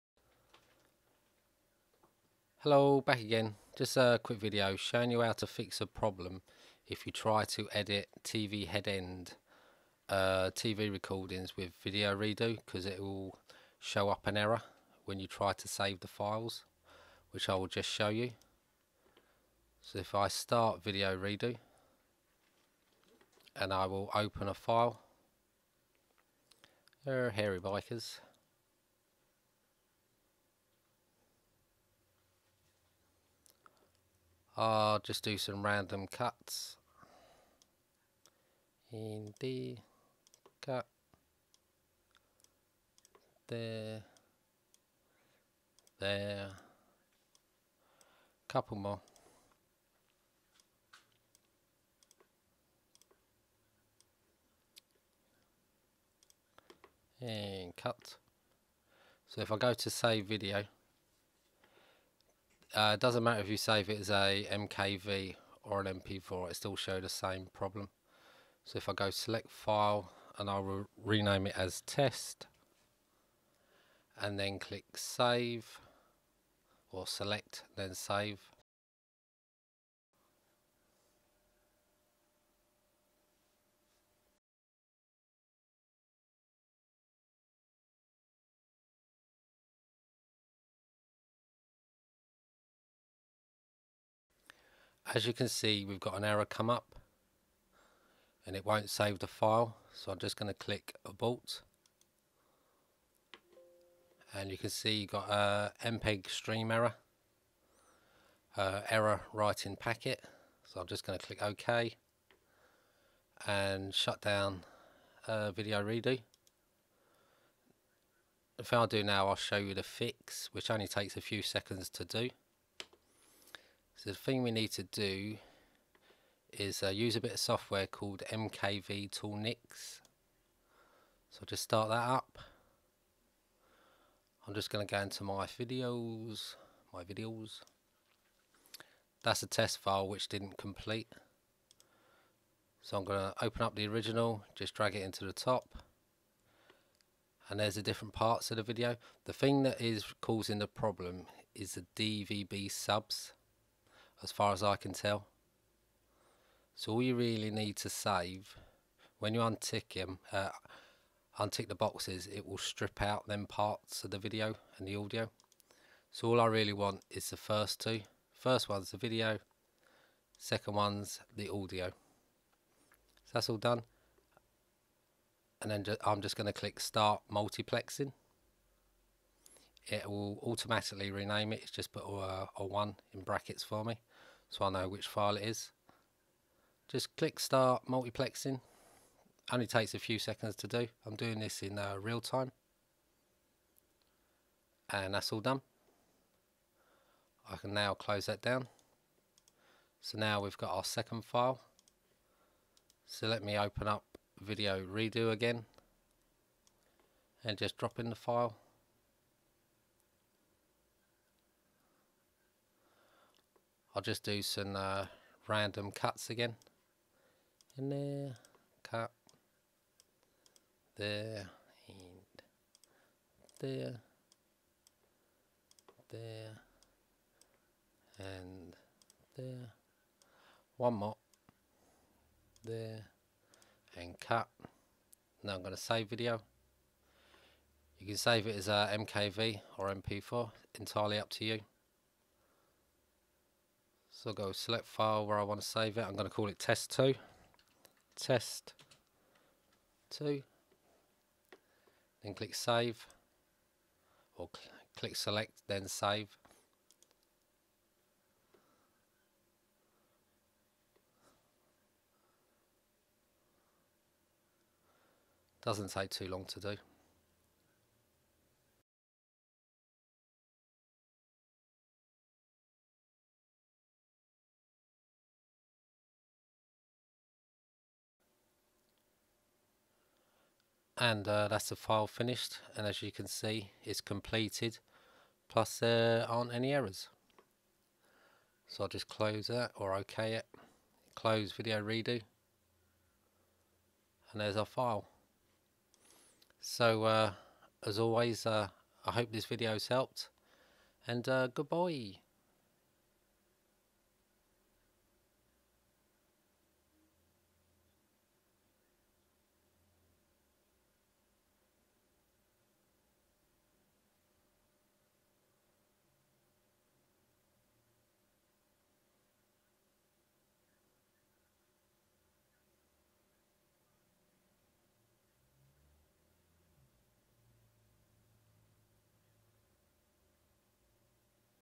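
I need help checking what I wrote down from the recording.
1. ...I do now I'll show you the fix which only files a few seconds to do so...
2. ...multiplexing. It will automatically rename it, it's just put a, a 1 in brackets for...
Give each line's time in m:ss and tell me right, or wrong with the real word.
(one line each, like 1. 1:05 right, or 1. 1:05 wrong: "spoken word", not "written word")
1. 1:58 wrong: "takes", not "files"
2. 2:57 right.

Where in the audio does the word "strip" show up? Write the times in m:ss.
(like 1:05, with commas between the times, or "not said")
2:42.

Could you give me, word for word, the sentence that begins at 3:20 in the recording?
So now we've got our second file.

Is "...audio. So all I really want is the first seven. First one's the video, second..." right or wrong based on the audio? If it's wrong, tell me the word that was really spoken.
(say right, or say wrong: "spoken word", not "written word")
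wrong: "two", not "seven".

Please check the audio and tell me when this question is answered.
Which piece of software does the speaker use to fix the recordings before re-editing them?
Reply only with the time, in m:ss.
2:08.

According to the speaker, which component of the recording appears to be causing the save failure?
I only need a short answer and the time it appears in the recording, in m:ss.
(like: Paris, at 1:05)
DVB subs, at 2:31.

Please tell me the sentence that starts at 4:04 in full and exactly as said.
So I'll go select file where I want to save it.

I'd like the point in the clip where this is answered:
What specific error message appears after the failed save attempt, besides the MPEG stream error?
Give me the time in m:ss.
1:48.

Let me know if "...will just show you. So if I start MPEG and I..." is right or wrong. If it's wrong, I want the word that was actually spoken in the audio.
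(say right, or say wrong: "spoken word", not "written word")
wrong: "VideoReDo", not "MPEG".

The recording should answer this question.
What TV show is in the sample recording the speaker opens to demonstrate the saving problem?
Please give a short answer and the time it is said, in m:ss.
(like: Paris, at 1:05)
Hairy Bikers, at 0:27.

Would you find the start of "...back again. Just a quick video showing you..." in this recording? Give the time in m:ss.
0:03.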